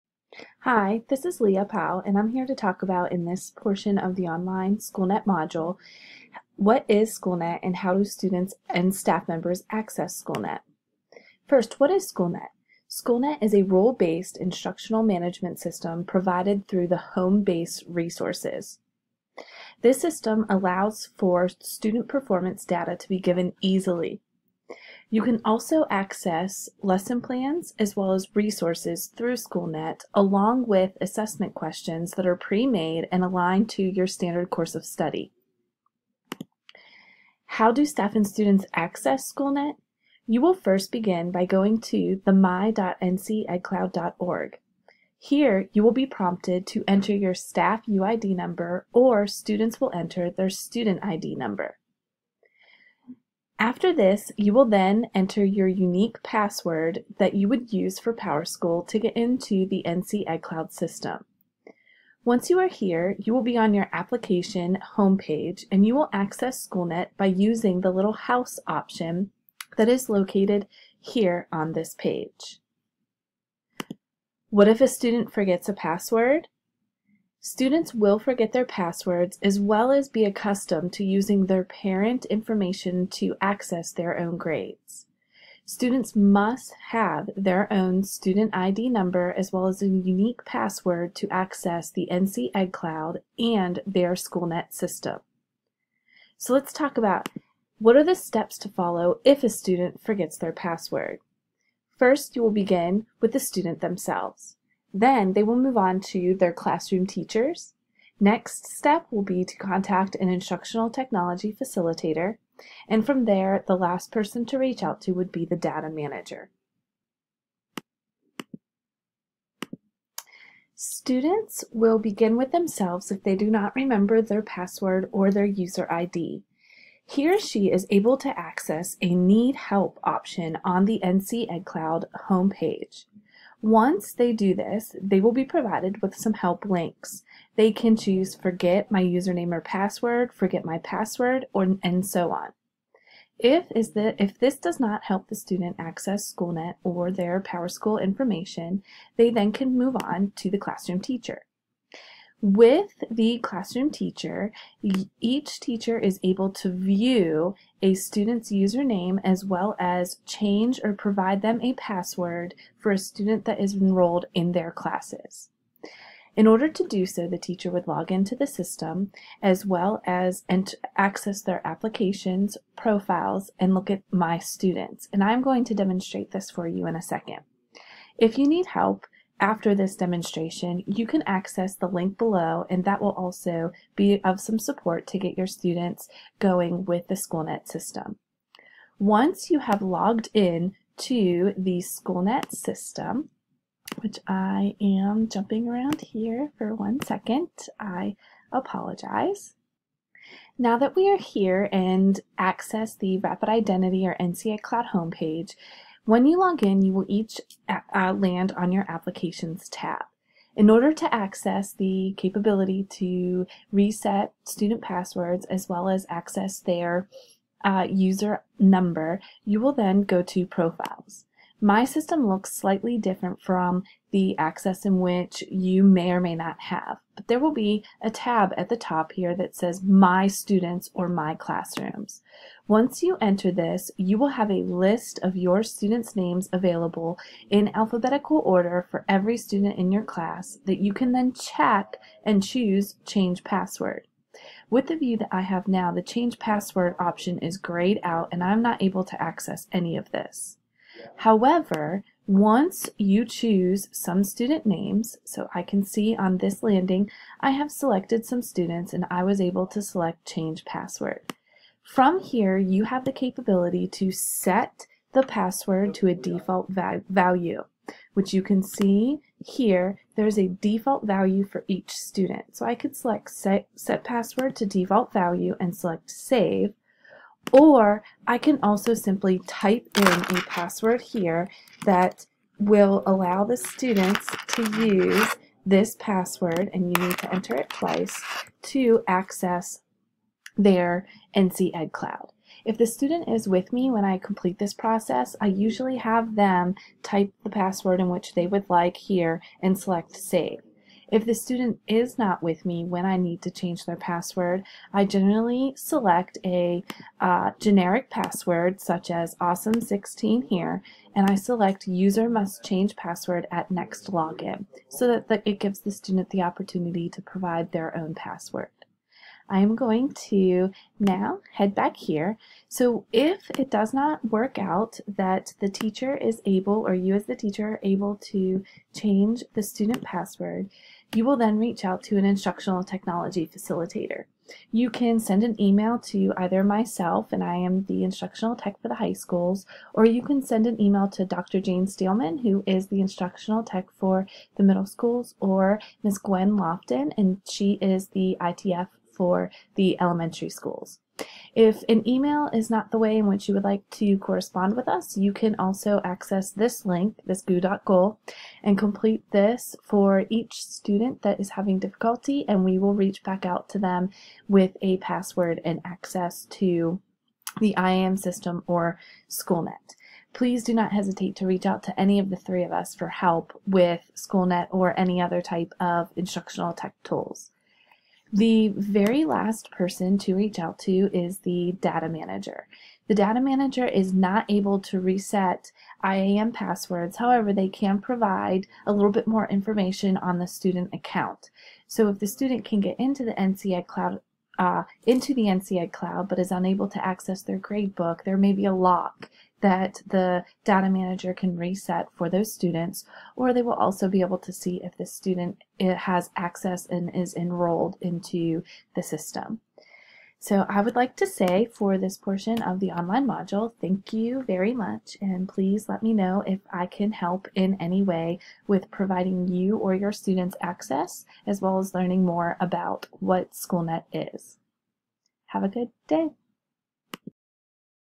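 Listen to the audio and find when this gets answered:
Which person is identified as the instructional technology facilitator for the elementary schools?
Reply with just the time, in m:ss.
5:46.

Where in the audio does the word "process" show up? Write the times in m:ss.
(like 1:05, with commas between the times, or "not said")
4:54.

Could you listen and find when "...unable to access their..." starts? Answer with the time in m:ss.
6:36.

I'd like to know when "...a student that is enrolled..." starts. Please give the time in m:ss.
2:42.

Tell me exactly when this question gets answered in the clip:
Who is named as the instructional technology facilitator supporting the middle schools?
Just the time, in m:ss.
5:41.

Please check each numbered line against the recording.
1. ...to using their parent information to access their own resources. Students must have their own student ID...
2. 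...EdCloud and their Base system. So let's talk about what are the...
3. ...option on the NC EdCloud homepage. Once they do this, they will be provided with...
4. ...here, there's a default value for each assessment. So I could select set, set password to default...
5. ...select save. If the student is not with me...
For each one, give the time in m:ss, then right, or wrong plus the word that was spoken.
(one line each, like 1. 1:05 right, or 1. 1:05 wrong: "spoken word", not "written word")
1. 1:20 wrong: "grades", not "resources"
2. 1:32 wrong: "SchoolNet", not "Base"
3. 2:10 right
4. 4:29 wrong: "student", not "assessment"
5. 4:59 right.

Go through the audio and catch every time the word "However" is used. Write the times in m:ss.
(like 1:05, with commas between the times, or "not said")
4:11, 6:27.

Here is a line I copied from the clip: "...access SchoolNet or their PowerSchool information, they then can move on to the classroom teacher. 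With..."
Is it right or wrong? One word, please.
right.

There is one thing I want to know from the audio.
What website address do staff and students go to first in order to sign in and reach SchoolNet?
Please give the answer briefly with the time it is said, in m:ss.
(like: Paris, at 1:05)
my.ncedcloud.org, at 0:42.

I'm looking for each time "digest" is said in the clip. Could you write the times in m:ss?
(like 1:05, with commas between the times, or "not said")
not said.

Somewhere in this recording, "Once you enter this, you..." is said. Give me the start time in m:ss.
3:52.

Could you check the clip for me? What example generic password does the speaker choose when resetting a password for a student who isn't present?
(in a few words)
awesome16.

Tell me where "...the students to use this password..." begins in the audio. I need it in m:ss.
4:43.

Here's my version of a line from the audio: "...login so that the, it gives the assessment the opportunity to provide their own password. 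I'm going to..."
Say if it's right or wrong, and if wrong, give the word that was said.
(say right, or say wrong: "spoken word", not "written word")
wrong: "student", not "assessment".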